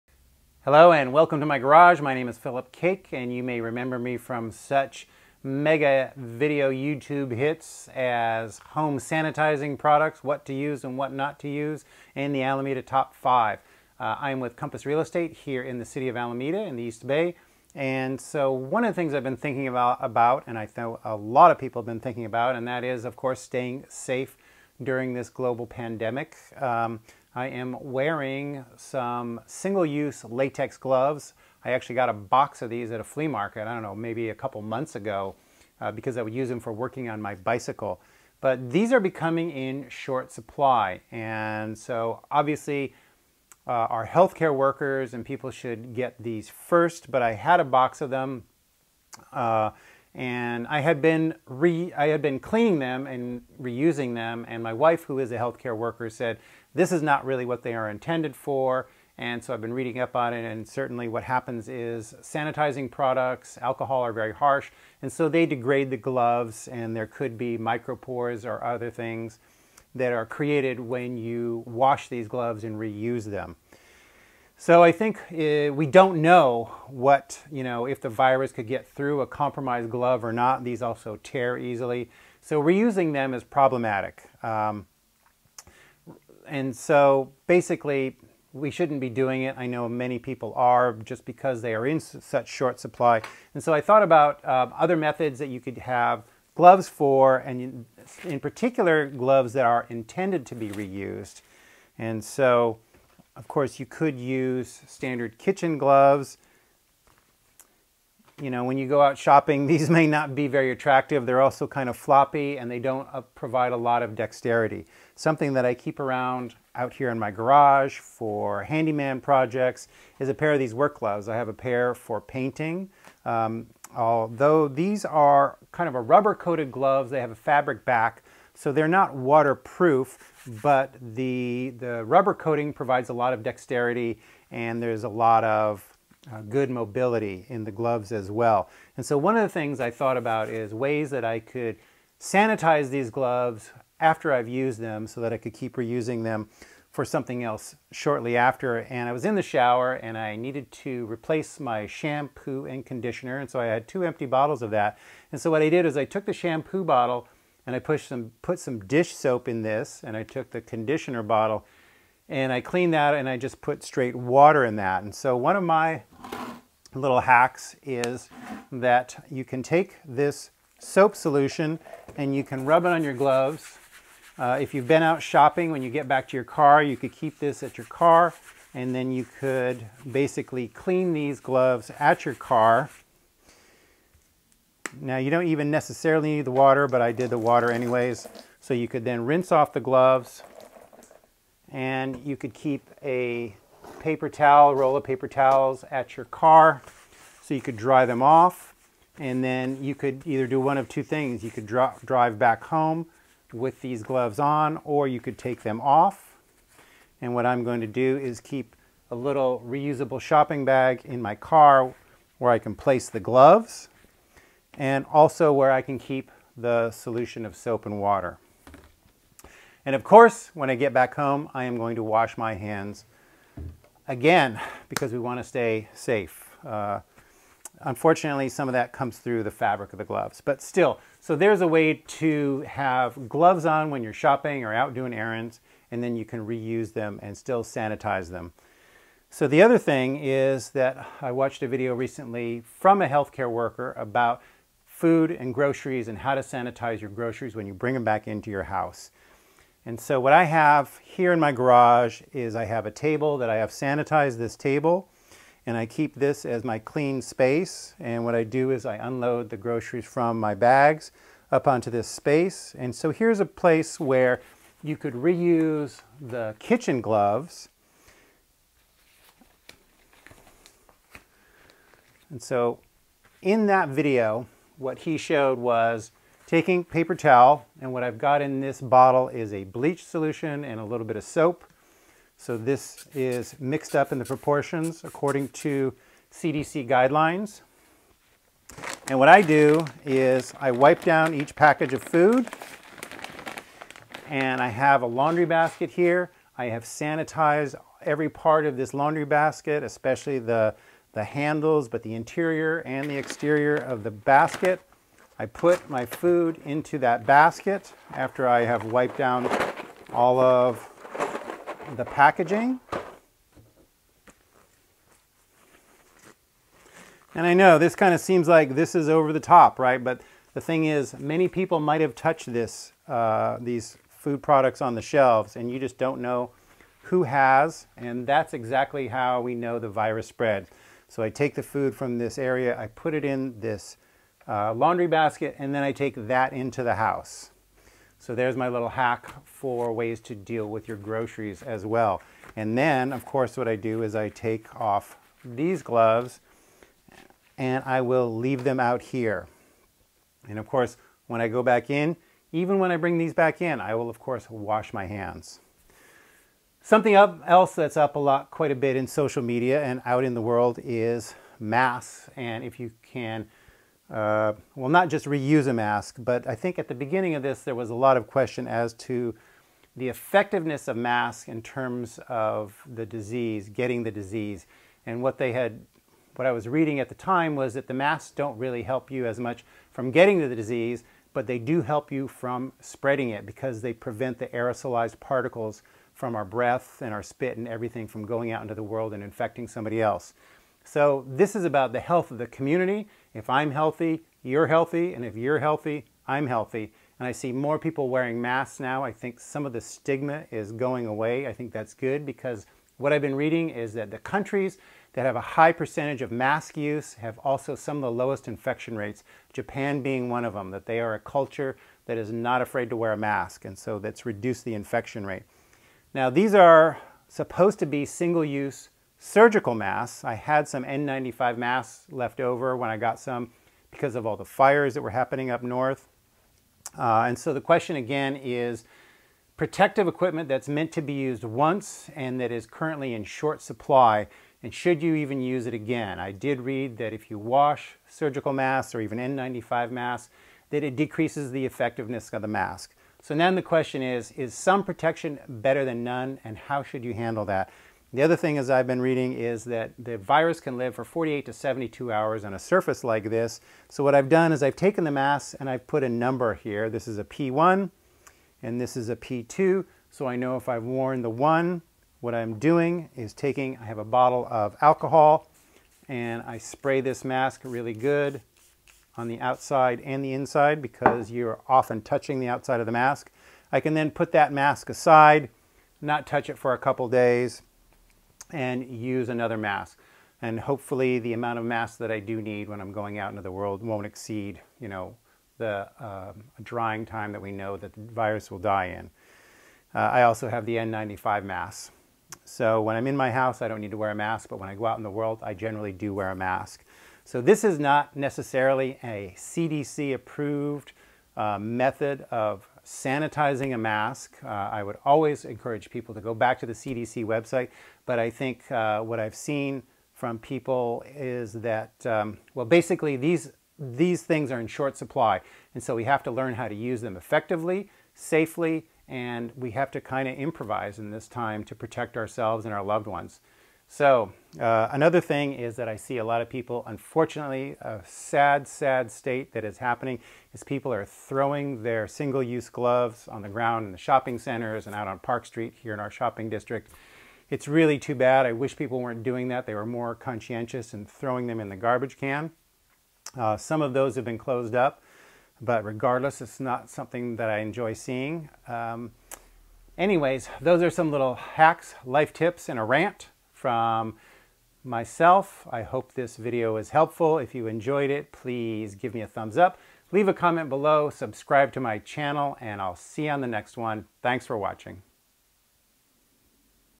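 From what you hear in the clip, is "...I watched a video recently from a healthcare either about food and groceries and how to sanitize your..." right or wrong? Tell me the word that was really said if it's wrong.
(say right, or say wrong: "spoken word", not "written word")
wrong: "worker", not "either".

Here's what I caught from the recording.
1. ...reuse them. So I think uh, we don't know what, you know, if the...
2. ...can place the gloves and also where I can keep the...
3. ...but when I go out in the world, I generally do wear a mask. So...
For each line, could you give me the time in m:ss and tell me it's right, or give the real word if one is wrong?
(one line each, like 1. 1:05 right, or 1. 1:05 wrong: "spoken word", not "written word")
1. 1:12 right
2. 3:32 right
3. 8:14 right.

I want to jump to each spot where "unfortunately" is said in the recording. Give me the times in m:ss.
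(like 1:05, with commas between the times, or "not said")
3:47, 8:46.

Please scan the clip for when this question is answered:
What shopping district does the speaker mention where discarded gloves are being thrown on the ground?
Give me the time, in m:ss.
8:55.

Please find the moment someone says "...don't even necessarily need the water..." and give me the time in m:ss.
3:05.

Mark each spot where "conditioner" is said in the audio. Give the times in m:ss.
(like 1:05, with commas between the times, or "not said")
2:32, 2:40.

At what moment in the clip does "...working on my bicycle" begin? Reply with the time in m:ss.
0:36.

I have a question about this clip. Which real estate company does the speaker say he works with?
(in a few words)
Compass Real Estate.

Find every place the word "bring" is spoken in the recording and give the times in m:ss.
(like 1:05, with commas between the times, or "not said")
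4:07, 5:52.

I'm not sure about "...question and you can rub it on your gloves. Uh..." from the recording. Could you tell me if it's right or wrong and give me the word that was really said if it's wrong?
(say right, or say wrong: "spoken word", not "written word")
wrong: "solution", not "question".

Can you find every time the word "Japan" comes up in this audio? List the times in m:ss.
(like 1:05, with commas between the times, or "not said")
6:49.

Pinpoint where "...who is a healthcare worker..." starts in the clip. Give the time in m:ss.
0:55.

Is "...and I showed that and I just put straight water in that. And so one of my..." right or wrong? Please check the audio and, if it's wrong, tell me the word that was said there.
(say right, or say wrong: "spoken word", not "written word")
wrong: "cleaned", not "showed".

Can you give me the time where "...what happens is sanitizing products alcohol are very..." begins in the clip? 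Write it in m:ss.
1:01.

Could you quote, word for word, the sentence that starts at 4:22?
And so here's a place where you could reuse the kitchen gloves.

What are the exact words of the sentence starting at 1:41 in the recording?
And so of course, you could use standard kitchen gloves.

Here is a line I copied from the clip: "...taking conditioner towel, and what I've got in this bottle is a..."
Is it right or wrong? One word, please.
wrong.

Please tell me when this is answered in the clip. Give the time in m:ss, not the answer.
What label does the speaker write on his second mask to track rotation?
7:39.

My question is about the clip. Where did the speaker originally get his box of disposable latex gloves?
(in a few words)
A flea market.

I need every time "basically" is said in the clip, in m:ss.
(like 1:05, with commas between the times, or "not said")
1:27, 3:00, 8:32.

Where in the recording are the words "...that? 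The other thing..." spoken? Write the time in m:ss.
7:27.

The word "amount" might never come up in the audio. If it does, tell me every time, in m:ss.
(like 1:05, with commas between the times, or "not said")
8:01.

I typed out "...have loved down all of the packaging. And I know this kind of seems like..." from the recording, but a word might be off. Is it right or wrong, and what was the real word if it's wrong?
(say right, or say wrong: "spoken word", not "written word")
wrong: "wiped", not "loved".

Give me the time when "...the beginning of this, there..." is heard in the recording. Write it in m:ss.
6:06.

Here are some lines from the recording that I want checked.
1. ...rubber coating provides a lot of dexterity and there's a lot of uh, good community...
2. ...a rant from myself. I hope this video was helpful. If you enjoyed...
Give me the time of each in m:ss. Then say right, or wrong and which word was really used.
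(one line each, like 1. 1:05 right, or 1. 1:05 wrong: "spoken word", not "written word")
1. 2:12 wrong: "mobility", not "community"
2. 9:12 right.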